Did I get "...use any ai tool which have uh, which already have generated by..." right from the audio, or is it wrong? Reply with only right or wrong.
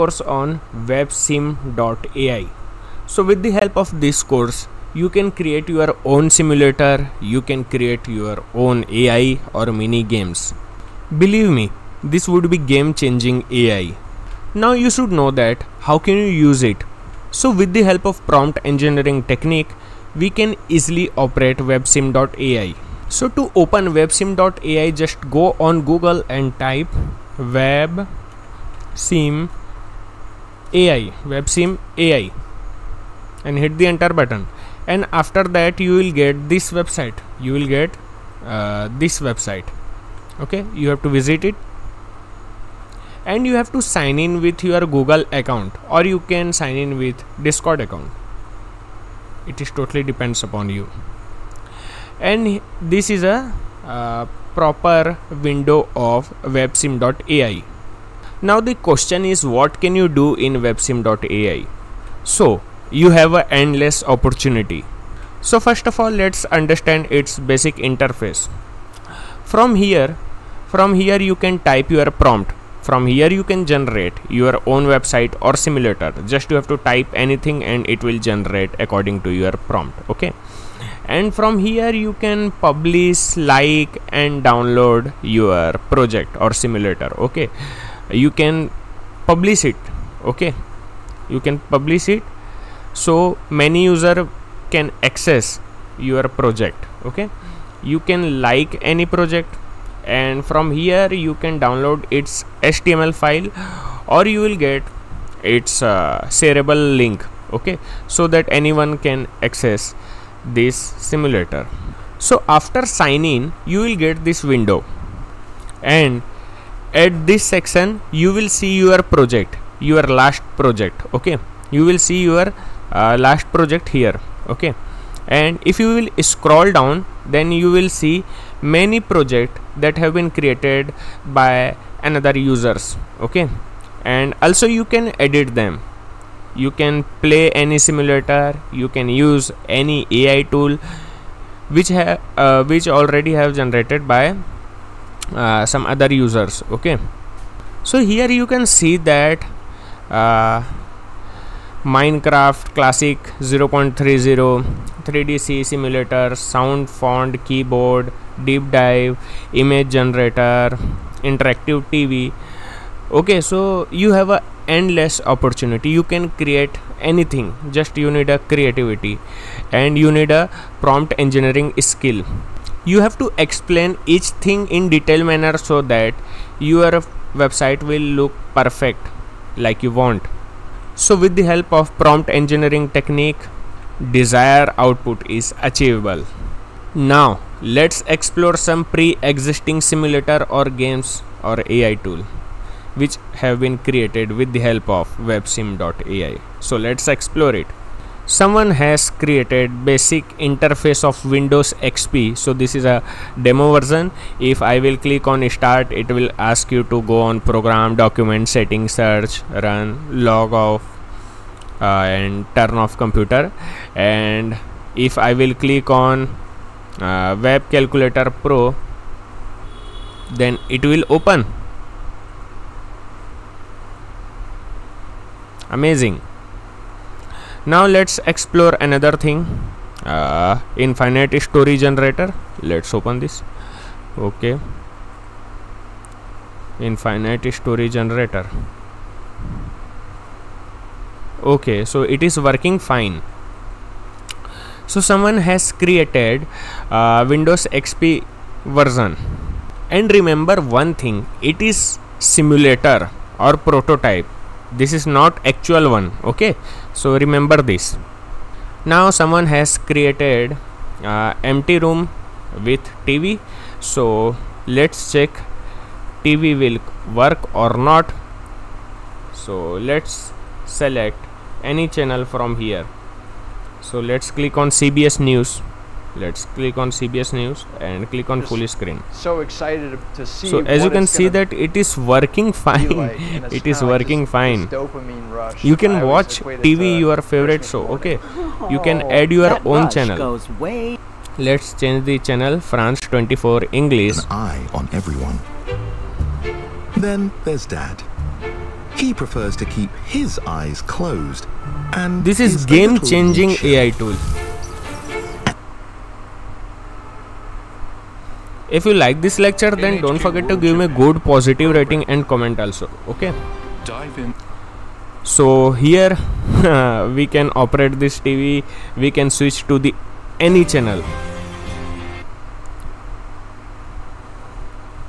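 right.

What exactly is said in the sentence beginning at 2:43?
Okay, so you have a endless opportunity.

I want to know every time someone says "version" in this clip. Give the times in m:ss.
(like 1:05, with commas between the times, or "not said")
3:23, 4:08.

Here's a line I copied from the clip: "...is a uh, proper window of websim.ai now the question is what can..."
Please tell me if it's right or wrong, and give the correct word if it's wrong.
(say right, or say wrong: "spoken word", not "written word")
right.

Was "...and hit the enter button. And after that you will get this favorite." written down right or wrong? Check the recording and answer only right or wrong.
wrong.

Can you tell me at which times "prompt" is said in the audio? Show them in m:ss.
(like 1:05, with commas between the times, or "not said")
0:18, 1:12, 1:19, 2:50, 3:01.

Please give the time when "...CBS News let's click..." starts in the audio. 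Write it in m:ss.
4:34.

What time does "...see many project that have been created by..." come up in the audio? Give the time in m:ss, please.
2:07.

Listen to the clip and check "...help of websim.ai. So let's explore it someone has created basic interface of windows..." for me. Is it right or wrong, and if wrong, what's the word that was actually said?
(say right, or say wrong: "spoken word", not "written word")
right.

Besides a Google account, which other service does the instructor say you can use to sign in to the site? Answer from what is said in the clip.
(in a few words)
Discord.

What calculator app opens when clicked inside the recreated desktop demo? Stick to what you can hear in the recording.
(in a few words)
Web Calculator Pro.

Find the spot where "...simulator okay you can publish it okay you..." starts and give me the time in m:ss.
1:26.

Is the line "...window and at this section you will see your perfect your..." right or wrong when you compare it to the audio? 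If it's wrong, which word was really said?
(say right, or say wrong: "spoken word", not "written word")
wrong: "project", not "perfect".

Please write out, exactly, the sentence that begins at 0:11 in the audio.
Believe me, this would be game changing AI.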